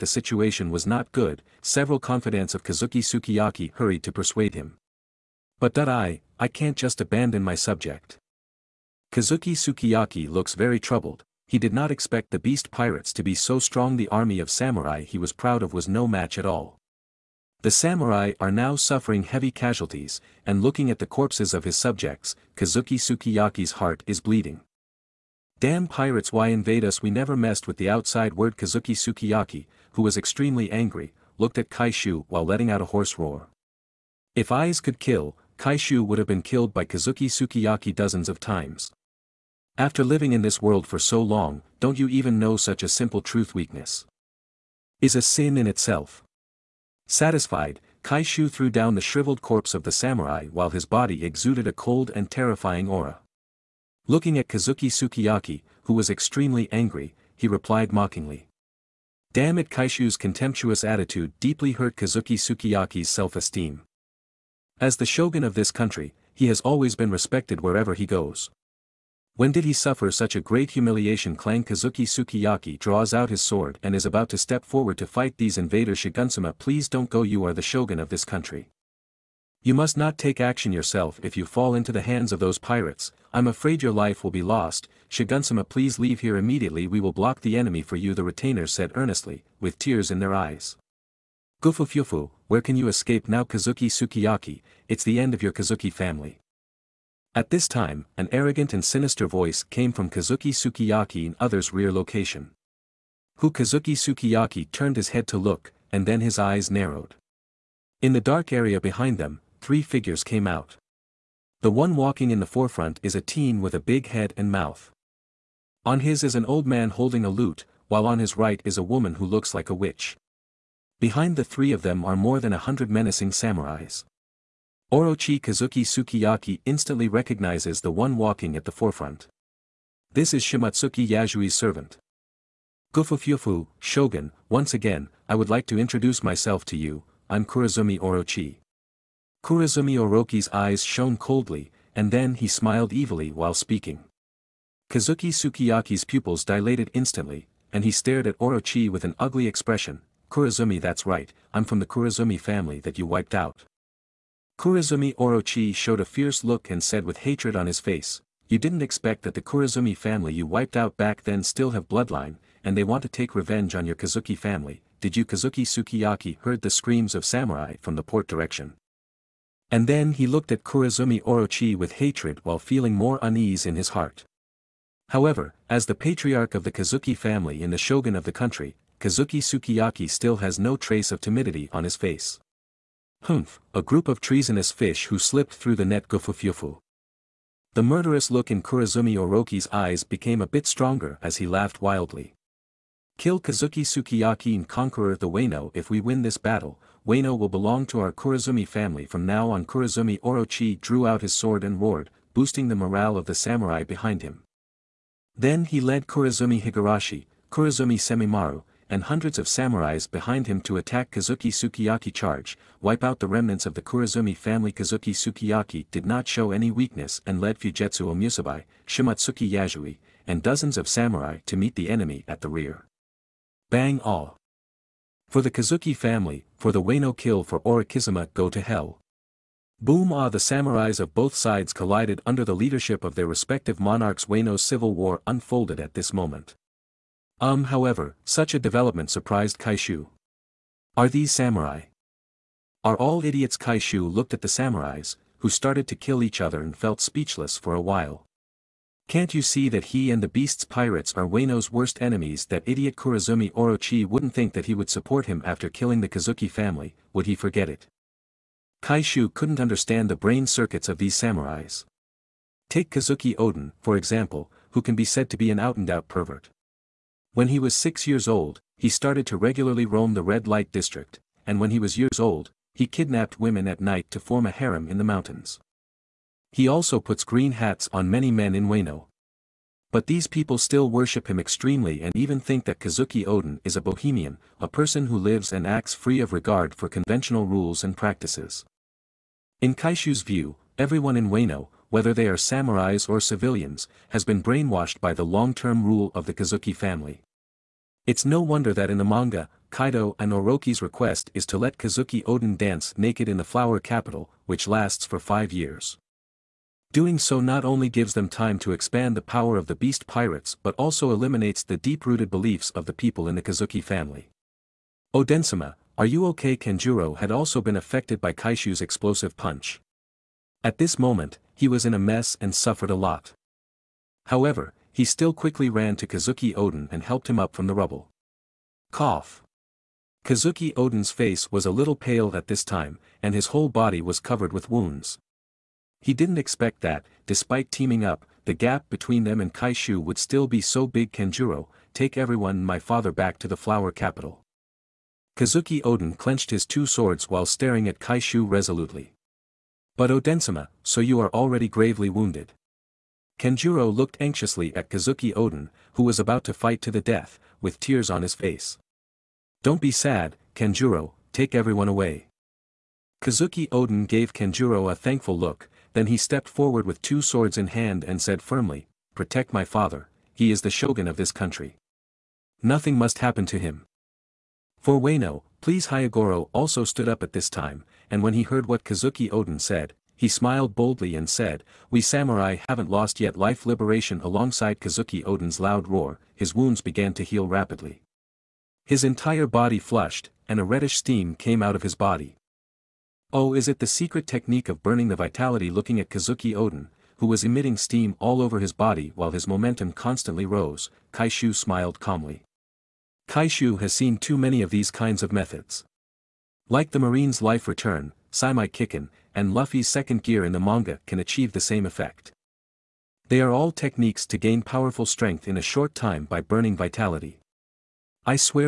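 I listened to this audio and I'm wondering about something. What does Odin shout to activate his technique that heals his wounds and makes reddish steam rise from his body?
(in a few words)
Life liberation.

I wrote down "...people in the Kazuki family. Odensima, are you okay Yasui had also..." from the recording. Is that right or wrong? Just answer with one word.
wrong.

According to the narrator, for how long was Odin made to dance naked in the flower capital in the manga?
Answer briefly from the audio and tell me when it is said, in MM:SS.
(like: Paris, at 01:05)
5 years, at 05:05.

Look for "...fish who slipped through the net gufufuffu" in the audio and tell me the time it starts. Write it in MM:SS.
03:04.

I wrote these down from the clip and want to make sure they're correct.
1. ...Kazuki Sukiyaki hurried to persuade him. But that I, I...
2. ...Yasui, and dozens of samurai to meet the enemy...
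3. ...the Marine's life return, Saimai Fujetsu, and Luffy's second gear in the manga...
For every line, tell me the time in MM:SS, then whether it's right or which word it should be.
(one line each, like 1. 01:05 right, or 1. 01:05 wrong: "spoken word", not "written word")
1. 00:02 right
2. 03:39 right
3. 06:46 wrong: "Kikin", not "Fujetsu".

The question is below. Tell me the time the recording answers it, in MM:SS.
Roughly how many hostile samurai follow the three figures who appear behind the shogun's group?
02:02.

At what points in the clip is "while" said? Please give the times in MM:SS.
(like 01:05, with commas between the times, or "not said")
00:32, 00:50, 01:57, 02:23, 02:52, 04:07, 05:47, 06:39.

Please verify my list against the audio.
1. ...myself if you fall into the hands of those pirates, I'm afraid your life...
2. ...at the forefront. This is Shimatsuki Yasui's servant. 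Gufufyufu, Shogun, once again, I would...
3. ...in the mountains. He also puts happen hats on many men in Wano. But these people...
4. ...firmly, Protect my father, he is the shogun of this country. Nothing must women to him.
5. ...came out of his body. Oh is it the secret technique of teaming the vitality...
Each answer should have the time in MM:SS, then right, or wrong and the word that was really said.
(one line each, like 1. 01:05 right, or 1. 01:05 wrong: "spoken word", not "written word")
1. 01:20 wrong: "yourself", not "myself"
2. 02:08 right
3. 04:34 wrong: "green", not "happen"
4. 06:08 wrong: "happen", not "women"
5. 06:31 wrong: "burning", not "teaming".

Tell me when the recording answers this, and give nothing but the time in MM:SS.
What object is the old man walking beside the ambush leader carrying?
01:57.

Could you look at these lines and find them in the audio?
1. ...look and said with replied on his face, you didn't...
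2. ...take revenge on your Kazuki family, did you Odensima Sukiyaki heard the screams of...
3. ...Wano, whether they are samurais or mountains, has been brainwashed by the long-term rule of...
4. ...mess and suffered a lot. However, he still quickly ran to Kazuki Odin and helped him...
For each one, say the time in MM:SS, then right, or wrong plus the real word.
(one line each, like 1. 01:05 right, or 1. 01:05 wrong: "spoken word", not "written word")
1. 02:36 wrong: "hatred", not "replied"
2. 02:43 wrong: "Kazuki", not "Odensima"
3. 04:51 wrong: "civilians", not "mountains"
4. 05:21 right.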